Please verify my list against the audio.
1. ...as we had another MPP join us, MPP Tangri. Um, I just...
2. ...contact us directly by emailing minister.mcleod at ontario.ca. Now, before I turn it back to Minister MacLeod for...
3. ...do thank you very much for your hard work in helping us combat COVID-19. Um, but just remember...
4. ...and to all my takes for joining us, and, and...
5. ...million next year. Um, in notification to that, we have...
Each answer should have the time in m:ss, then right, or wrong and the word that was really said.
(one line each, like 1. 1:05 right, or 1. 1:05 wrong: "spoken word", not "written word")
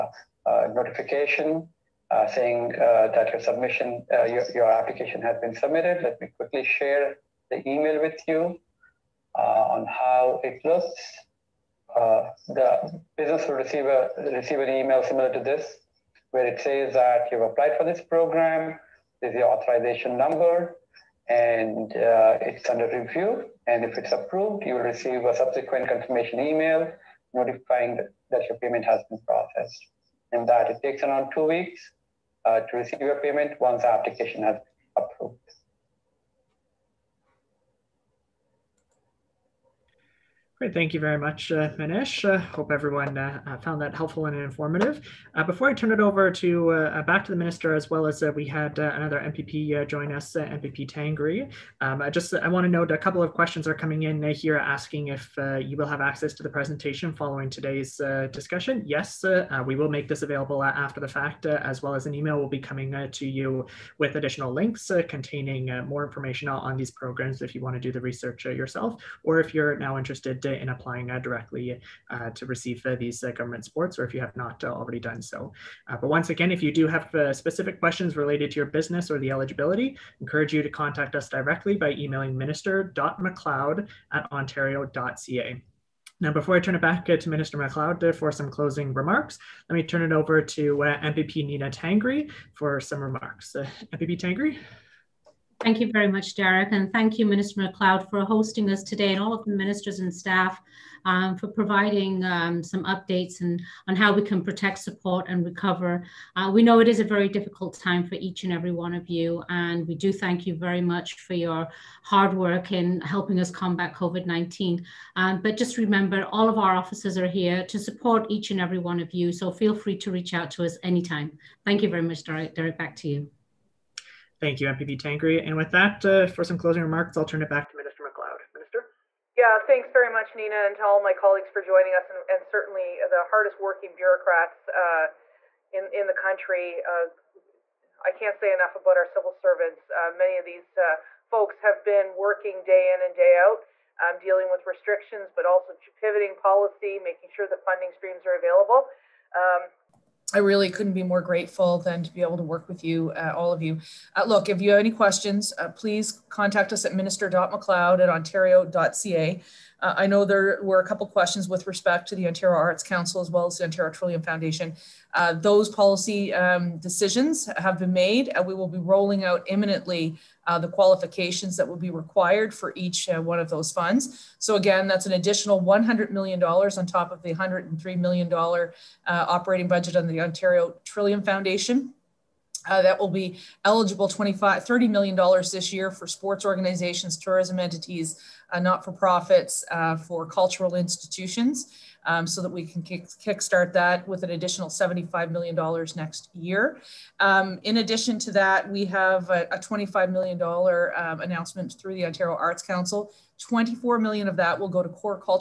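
1. 0:48 right
2. 1:20 right
3. 1:49 right
4. 2:10 wrong: "colleagues", not "takes"
5. 3:15 wrong: "addition", not "notification".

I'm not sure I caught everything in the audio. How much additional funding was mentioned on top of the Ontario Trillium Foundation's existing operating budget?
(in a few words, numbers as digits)
$100 million.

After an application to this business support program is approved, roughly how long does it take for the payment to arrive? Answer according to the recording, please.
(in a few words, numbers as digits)
2 weeks.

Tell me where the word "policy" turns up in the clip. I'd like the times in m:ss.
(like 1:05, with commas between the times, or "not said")
2:26, 2:45.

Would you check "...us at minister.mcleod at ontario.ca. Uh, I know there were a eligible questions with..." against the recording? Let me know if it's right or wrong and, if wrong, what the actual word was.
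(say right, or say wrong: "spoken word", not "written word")
wrong: "couple", not "eligible".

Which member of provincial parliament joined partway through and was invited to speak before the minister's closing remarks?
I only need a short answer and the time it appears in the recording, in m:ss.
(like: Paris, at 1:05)
Nina Tangri, at 1:31.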